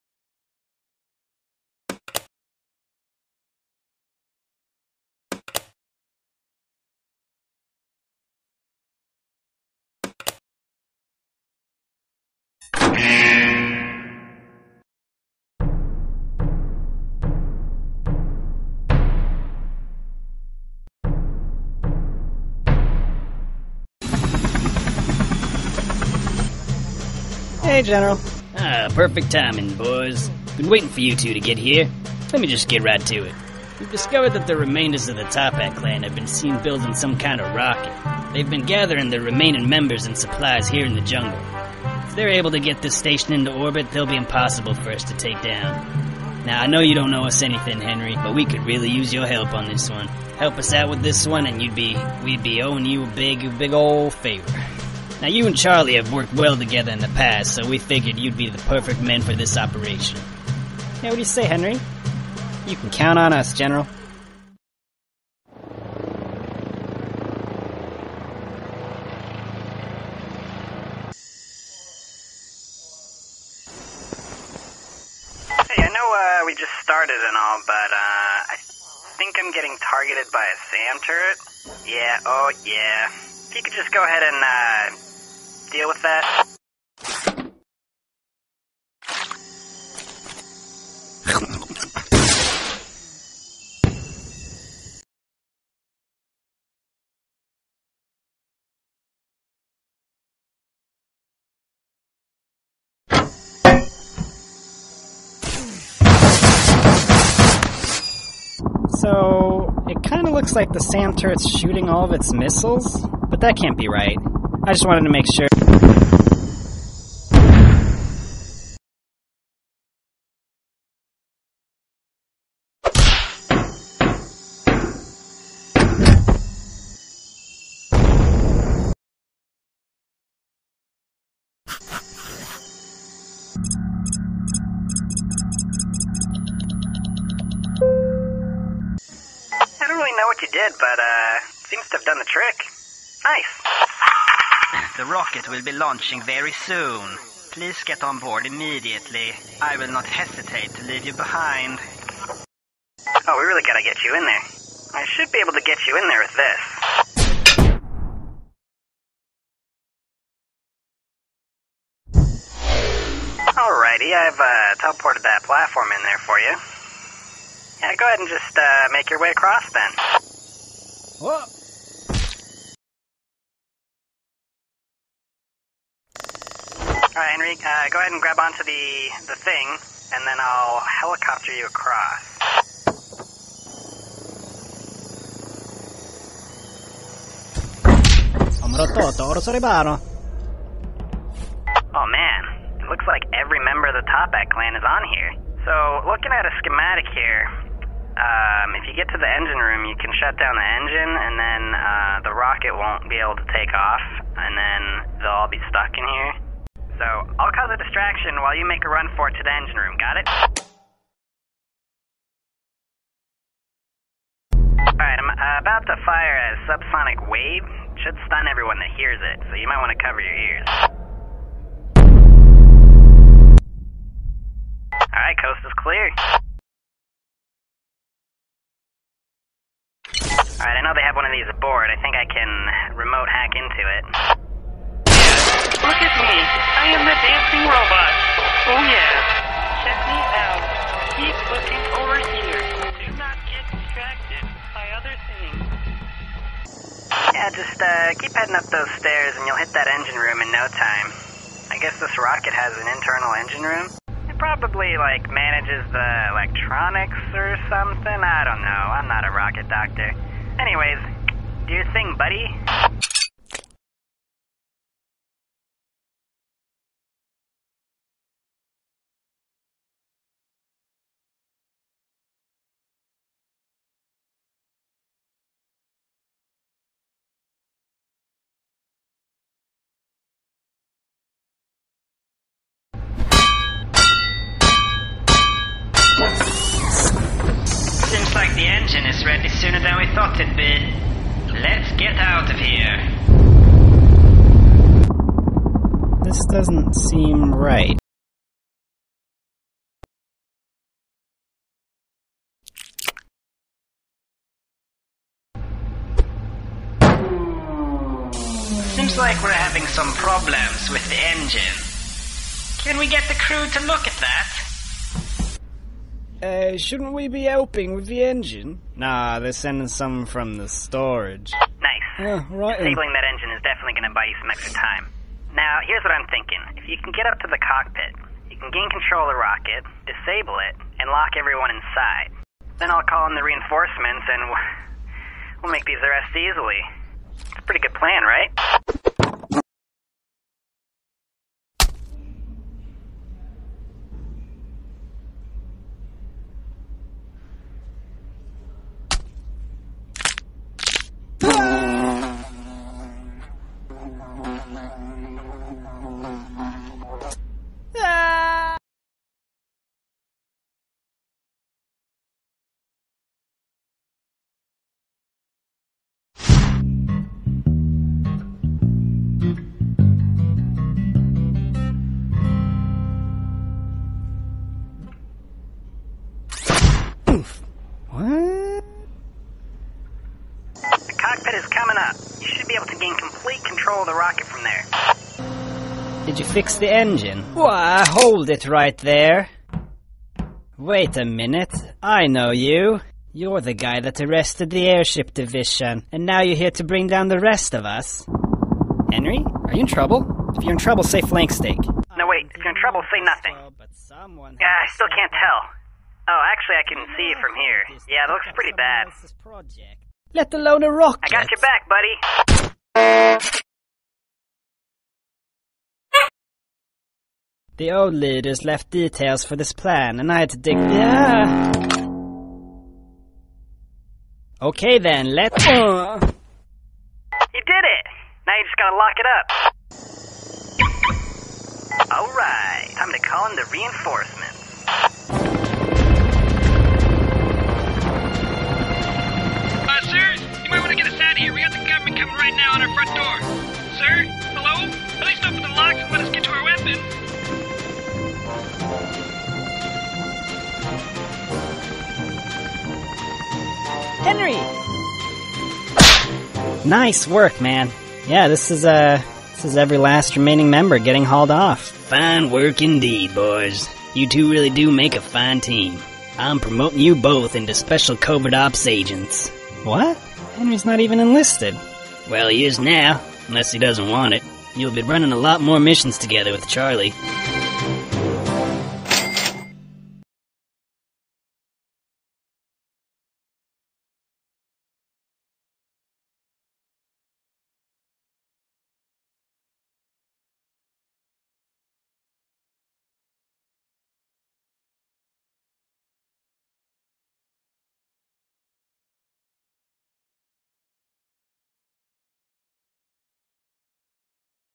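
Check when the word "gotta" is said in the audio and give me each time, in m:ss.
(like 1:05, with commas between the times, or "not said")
2:33, 7:08.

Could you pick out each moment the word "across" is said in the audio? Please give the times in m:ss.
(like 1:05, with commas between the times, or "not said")
2:49, 3:01.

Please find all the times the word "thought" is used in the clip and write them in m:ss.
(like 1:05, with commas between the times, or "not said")
4:50.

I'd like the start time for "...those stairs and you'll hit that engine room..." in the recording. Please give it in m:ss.
4:08.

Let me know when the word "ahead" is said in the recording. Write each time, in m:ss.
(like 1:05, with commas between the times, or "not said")
1:24, 2:48, 2:57.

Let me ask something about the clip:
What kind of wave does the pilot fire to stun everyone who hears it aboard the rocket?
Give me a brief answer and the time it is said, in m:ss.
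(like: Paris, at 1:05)
subsonic wave, at 3:36.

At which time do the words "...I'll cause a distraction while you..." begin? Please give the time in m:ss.
3:27.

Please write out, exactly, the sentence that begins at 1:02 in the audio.
You can count on us, General.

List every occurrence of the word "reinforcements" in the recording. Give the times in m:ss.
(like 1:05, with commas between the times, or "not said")
5:33, 7:13.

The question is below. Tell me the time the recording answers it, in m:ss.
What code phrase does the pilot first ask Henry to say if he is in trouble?
6:41.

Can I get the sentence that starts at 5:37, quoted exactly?
It's a pretty good plan, right?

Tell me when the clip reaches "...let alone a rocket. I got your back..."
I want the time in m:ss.
6:50.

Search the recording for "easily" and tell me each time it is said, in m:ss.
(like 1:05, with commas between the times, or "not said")
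5:36.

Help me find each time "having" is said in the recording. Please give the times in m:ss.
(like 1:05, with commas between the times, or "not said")
5:09.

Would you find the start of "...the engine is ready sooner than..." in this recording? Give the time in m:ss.
4:48.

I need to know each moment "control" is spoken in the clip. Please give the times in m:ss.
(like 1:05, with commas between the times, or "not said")
5:28, 6:23.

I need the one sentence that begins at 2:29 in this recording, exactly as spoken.
I will not hesitate to leave you behind.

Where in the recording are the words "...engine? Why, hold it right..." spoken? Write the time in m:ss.
6:26.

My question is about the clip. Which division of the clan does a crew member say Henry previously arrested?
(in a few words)
the airship division.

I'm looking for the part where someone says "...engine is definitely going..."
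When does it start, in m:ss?
5:23.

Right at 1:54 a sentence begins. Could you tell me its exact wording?
I just wanted to make sure.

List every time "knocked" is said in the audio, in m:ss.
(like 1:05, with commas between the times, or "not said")
not said.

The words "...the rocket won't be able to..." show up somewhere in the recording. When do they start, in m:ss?
3:22.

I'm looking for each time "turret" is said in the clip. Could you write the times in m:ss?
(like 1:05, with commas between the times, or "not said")
1:21, 1:51.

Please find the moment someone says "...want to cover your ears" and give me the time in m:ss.
3:39.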